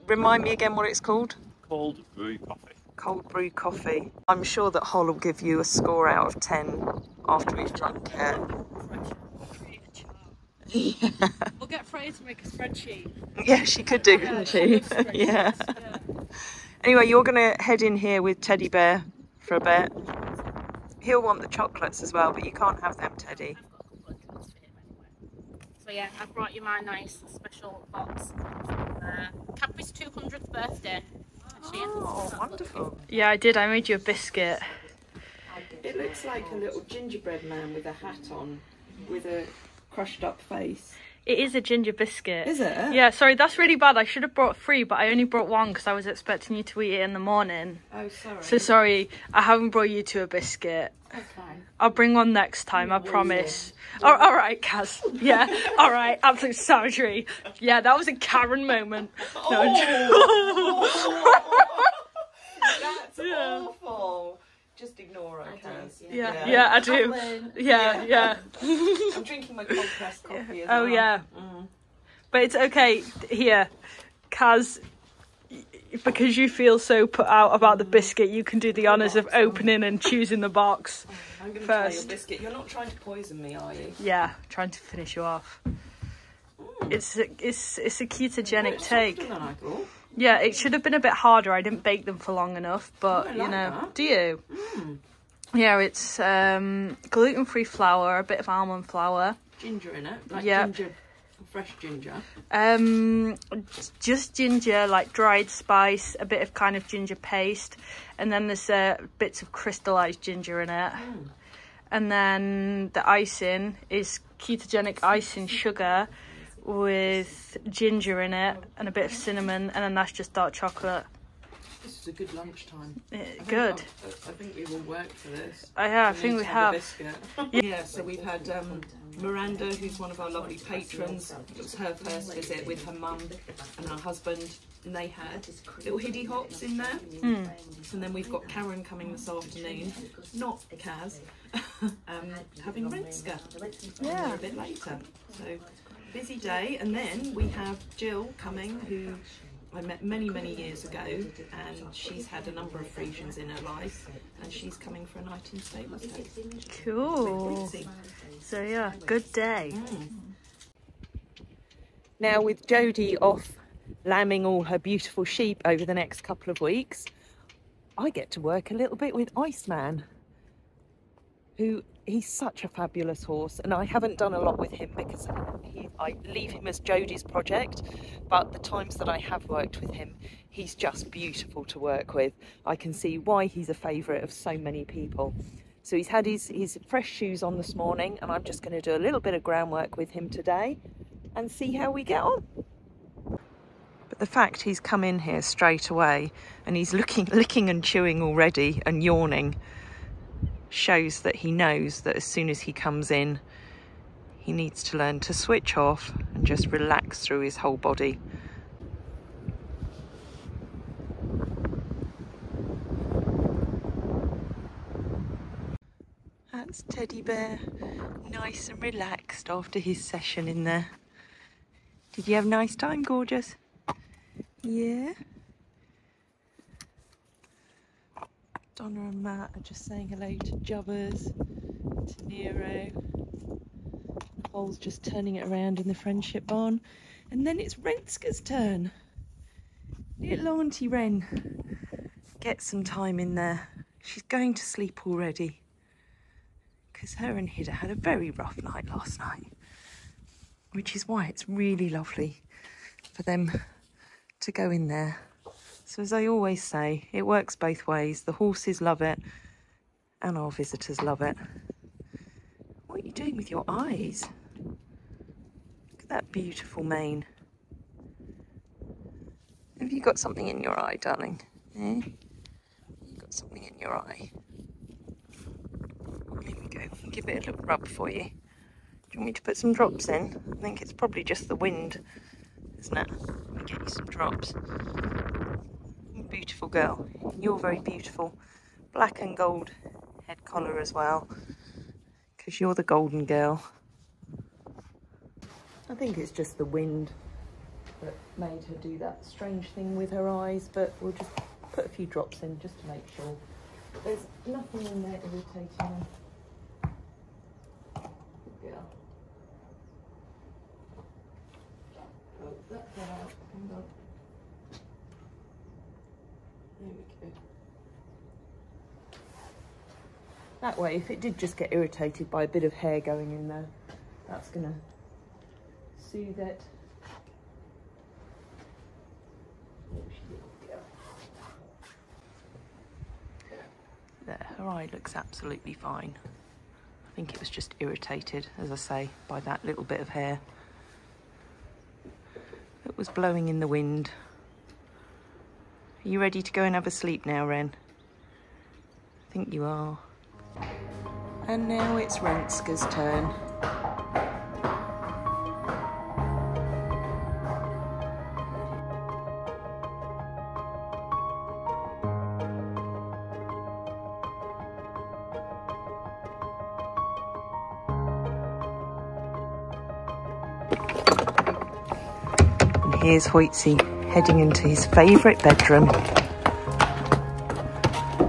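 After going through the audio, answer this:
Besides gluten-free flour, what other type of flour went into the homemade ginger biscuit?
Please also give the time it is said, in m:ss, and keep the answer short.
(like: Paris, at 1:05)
almond flour, at 1:38.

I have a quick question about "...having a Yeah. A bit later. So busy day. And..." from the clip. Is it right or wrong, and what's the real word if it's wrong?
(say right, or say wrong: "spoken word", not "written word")
right.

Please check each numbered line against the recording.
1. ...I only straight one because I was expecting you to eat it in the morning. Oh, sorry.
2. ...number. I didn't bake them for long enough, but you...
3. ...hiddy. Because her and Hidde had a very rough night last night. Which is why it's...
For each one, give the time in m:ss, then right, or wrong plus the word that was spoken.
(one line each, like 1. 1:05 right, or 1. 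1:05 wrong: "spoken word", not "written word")
1. 0:44 wrong: "brought", not "straight"
2. 1:31 wrong: "harder", not "number"
3. 4:05 wrong: "already", not "hiddy".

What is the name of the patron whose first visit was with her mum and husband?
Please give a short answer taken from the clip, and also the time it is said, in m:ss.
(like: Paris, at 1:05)
Miranda, at 2:09.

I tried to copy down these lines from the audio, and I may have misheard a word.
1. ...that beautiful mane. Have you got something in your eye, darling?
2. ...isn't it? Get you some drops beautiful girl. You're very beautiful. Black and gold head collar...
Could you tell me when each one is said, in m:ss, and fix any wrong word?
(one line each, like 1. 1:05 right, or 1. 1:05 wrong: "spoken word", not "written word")
1. 4:26 right
2. 4:42 right.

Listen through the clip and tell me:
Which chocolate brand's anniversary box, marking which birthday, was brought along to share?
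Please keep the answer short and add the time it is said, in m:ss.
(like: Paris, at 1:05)
Cadbury's 200th, at 0:29.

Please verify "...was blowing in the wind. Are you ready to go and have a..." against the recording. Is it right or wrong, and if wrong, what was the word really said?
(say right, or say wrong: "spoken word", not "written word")
right.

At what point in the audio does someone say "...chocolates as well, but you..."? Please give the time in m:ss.
0:21.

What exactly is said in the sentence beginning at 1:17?
biscuit, you can do the honours of opening and choosing the box.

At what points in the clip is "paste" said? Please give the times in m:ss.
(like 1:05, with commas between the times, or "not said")
1:47.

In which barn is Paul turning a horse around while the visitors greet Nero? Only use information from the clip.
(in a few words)
friendship barn.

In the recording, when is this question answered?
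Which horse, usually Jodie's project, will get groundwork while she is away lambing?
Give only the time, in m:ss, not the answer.
2:49.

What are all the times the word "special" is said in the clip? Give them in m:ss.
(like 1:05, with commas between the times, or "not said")
0:27.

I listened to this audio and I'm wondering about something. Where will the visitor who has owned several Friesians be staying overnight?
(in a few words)
Stable Stays.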